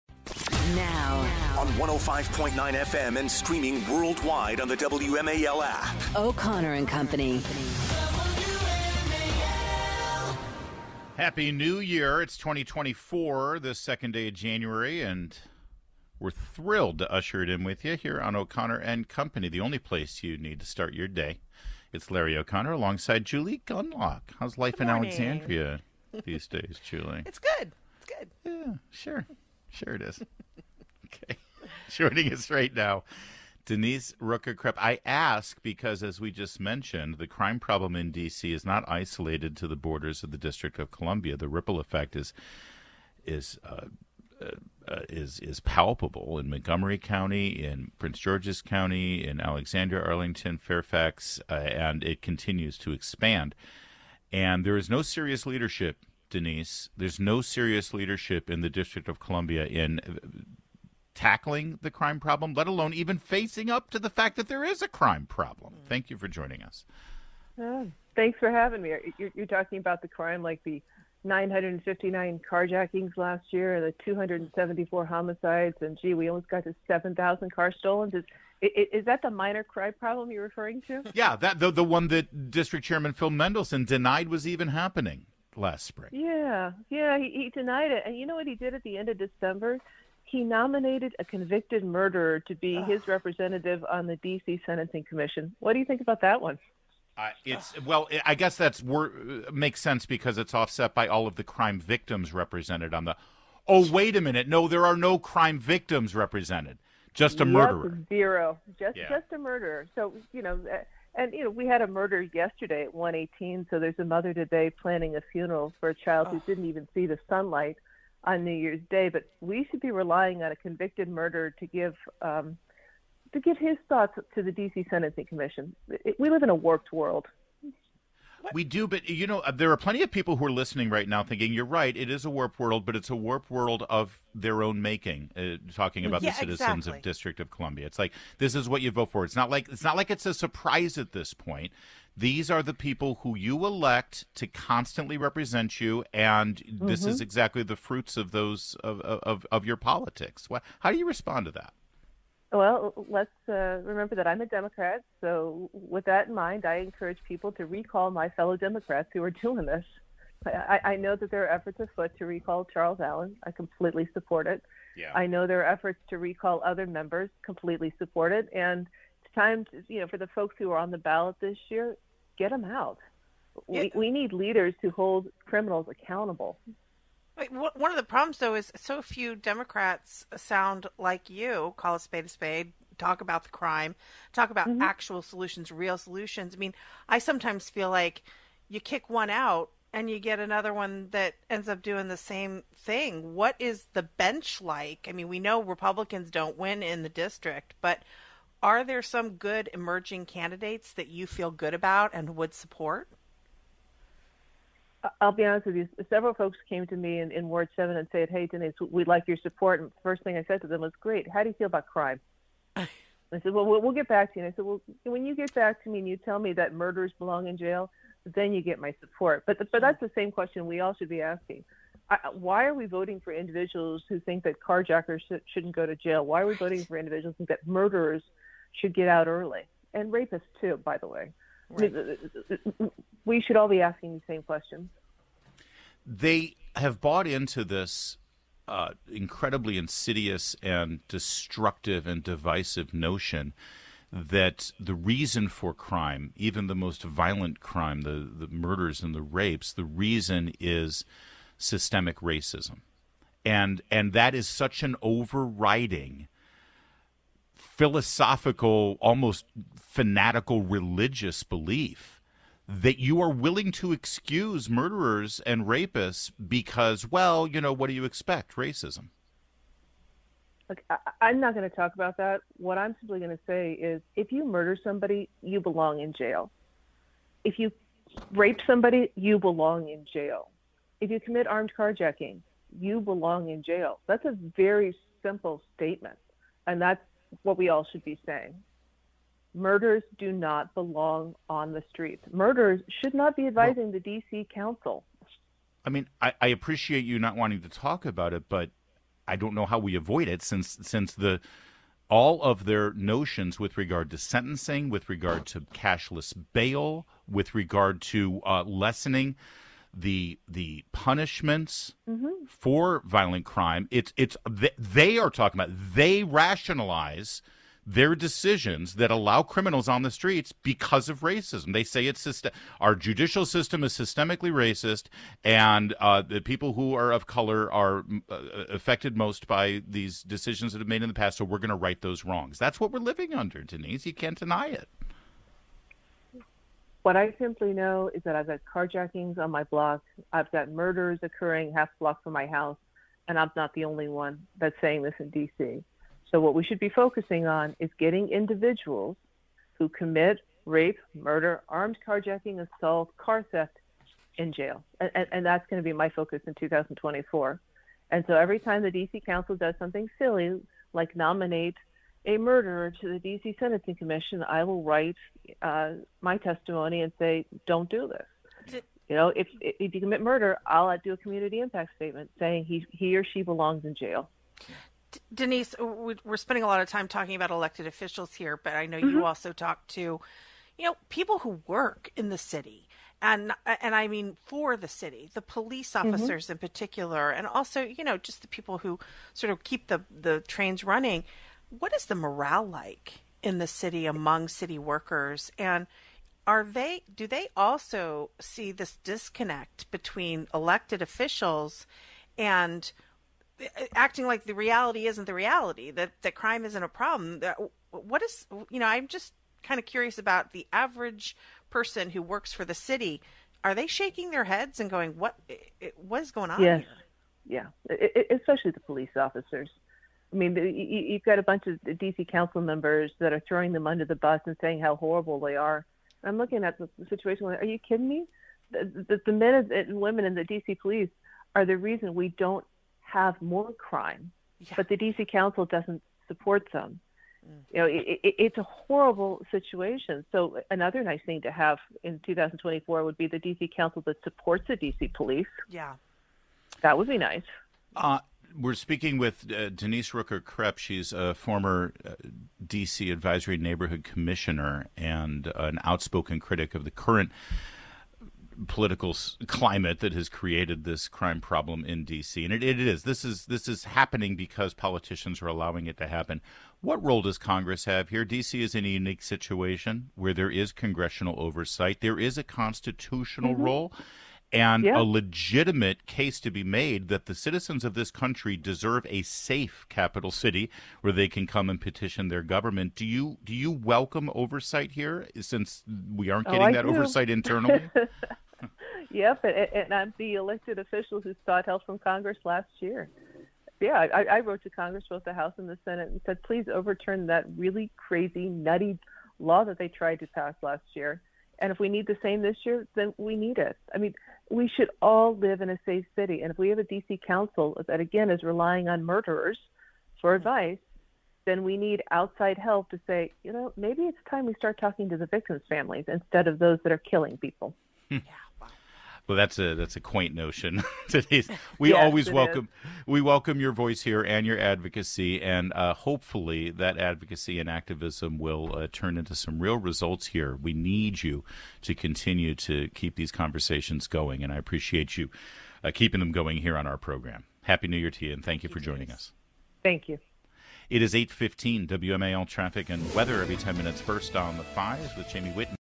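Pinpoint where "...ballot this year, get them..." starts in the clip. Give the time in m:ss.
2:50.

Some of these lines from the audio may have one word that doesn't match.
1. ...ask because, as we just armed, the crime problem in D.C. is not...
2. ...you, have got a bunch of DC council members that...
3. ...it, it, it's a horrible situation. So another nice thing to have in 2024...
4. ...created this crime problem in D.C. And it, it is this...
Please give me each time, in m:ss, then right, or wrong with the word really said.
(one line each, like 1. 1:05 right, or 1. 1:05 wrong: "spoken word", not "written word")
1. 0:35 wrong: "mentioned", not "armed"
2. 7:00 right
3. 7:17 right
4. 7:40 right.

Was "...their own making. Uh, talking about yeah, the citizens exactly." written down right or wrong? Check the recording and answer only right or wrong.
right.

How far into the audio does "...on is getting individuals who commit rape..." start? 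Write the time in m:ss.
5:47.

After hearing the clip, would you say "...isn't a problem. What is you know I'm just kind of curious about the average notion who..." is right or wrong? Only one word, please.
wrong.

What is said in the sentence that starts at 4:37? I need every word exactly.
If you rape somebody, you belong in jail.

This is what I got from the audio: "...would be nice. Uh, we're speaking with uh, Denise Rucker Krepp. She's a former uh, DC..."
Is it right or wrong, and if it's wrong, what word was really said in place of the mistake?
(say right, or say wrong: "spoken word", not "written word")
right.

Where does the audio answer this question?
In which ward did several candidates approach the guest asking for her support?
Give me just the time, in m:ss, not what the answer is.
3:27.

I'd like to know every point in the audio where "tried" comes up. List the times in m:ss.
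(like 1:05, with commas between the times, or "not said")
8:19.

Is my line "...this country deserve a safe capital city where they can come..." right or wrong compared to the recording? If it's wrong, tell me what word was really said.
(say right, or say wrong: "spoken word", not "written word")
right.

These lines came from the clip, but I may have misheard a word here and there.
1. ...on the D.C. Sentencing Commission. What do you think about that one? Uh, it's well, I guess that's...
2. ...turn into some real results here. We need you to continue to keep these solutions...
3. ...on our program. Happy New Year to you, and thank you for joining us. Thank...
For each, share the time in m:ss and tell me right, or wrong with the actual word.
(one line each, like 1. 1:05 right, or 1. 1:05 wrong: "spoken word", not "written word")
1. 1:33 right
2. 8:48 wrong: "conversations", not "solutions"
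3. 8:56 right.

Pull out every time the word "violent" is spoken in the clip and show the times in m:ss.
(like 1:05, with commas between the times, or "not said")
4:07, 5:13.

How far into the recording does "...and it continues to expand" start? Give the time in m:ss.
0:51.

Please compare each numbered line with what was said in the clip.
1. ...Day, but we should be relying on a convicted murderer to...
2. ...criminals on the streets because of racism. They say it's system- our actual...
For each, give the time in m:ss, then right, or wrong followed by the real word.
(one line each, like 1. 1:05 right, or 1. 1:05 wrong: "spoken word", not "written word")
1. 1:58 right
2. 5:19 wrong: "judicial", not "actual".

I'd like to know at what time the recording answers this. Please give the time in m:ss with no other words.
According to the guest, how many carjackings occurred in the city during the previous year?
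1:11.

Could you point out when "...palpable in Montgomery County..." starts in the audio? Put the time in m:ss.
0:45.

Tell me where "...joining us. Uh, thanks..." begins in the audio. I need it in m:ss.
1:06.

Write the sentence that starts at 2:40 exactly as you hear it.
I, I know that there are efforts afoot to recall Charles Allen.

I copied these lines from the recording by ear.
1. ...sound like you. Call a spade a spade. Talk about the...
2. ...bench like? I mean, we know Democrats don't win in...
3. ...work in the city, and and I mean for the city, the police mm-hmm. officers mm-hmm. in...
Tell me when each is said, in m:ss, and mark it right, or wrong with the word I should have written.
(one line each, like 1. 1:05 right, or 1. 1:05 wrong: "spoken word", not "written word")
1. 3:00 right
2. 3:14 wrong: "Republicans", not "Democrats"
3. 6:21 right.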